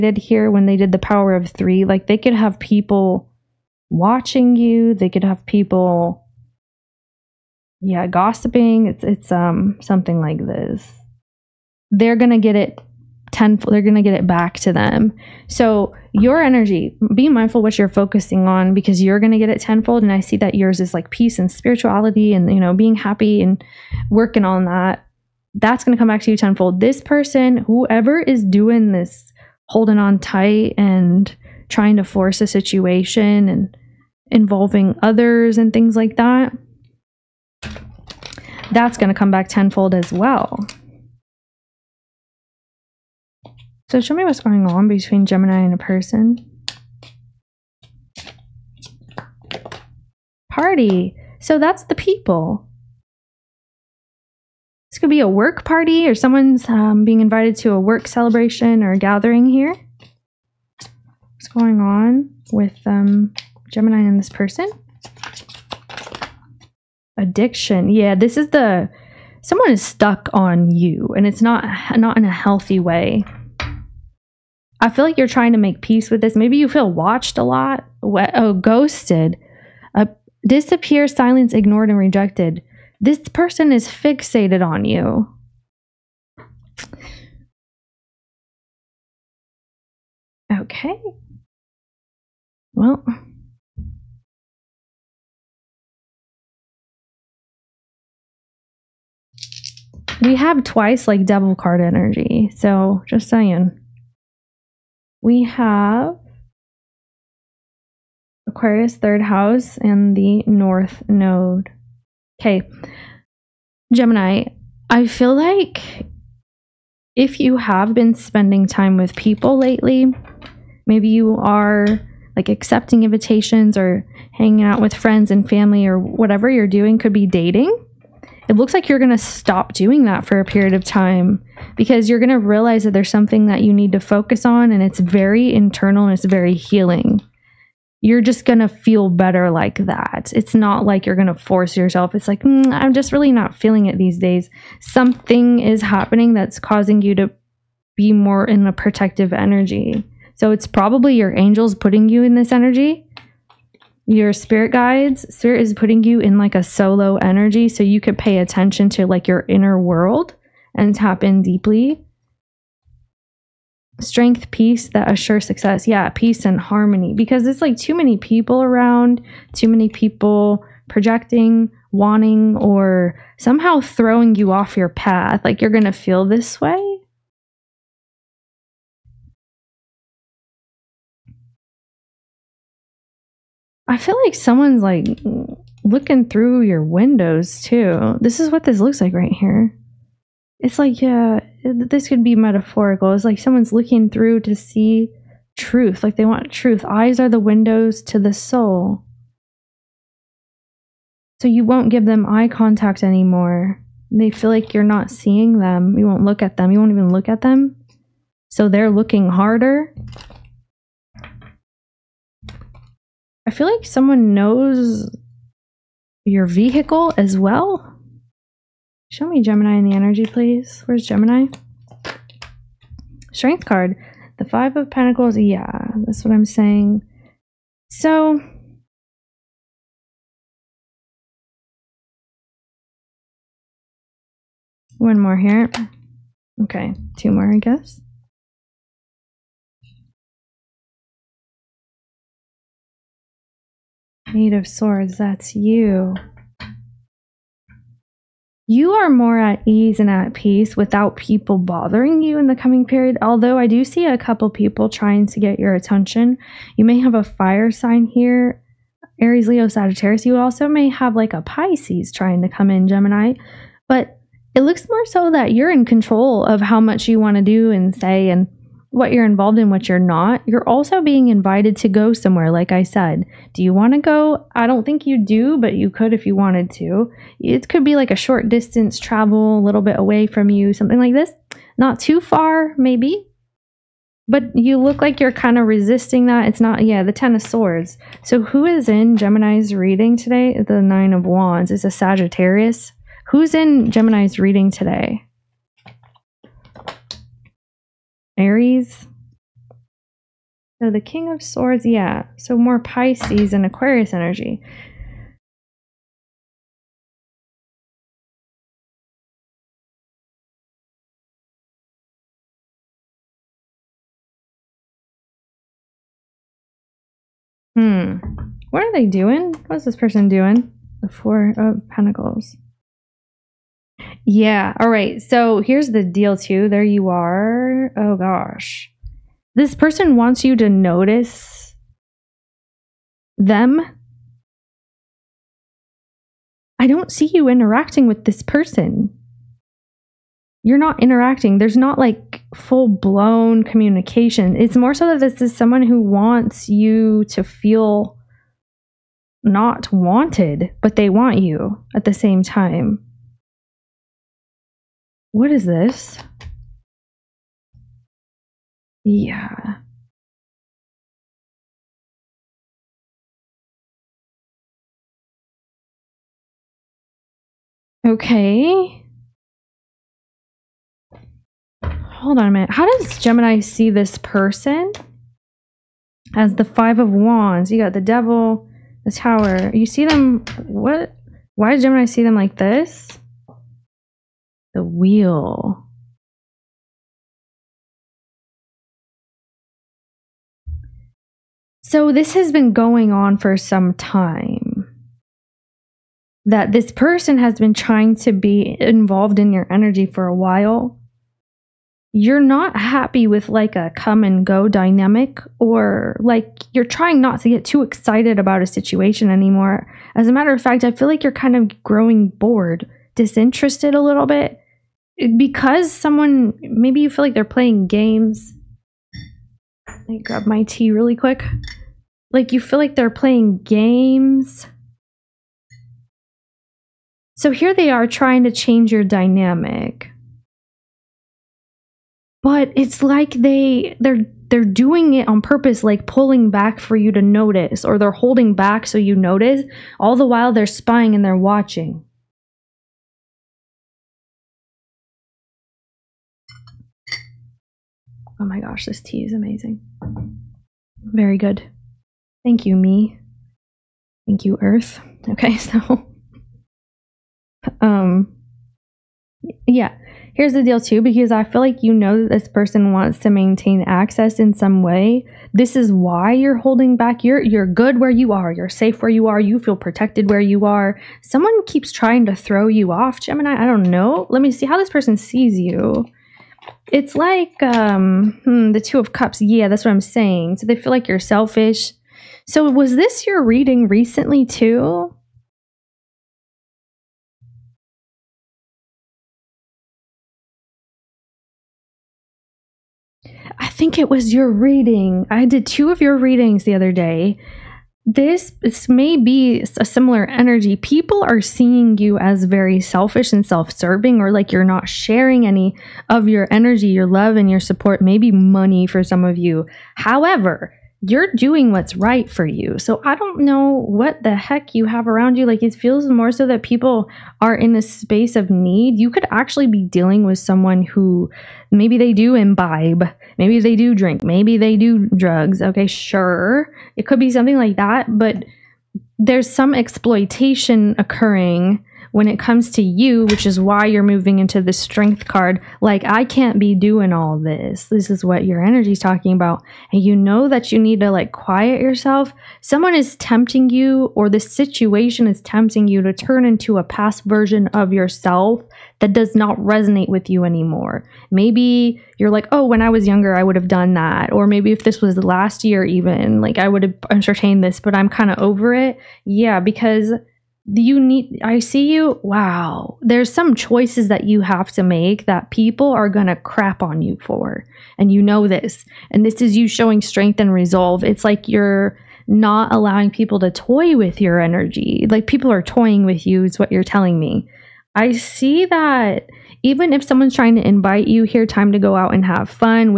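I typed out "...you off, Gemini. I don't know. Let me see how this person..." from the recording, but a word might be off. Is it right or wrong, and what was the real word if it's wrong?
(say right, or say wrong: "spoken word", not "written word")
right.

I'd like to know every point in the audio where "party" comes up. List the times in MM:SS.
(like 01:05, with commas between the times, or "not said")
00:50, 00:55.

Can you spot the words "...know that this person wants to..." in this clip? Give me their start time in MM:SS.
07:41.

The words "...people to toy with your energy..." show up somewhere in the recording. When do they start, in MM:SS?
09:33.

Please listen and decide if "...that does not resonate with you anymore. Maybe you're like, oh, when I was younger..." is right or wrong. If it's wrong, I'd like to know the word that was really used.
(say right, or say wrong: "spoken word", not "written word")
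right.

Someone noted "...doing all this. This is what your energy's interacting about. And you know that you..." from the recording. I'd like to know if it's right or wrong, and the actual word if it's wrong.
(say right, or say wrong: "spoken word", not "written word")
wrong: "talking", not "interacting".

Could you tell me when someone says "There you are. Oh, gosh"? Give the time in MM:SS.
05:26.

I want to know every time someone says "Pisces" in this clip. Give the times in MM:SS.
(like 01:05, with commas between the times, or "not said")
04:21, 05:02.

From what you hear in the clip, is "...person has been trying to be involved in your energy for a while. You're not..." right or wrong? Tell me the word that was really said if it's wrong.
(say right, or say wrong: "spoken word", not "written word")
right.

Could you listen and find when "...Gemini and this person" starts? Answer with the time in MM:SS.
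01:03.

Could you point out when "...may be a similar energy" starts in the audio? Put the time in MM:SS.
08:18.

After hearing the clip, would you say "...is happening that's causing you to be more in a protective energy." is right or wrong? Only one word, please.
right.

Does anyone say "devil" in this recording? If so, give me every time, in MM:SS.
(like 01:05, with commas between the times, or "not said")
01:41, 06:18.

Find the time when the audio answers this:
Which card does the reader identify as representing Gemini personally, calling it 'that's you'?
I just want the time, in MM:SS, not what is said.
04:04.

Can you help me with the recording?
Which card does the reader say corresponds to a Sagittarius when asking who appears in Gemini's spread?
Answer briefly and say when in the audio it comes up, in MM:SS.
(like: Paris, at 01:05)
Nine of Wands, at 04:50.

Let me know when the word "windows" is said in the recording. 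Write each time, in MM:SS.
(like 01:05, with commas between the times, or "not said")
03:06, 03:17.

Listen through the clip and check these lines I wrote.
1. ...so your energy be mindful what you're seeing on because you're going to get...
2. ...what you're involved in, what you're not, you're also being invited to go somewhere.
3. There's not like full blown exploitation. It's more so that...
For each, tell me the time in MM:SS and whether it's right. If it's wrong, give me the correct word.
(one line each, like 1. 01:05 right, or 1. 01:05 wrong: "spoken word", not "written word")
1. 00:15 wrong: "focusing", not "seeing"
2. 04:28 right
3. 05:41 wrong: "communication", not "exploitation".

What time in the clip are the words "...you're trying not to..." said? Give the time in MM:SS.
06:46.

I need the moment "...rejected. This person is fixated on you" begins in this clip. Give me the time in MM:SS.
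01:21.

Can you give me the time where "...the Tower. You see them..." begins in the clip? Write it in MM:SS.
06:19.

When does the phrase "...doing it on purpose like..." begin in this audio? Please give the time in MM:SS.
07:14.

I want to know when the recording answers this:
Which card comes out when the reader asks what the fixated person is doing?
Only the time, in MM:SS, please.
05:21.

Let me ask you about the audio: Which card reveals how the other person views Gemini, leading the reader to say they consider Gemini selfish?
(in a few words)
Two of Cups.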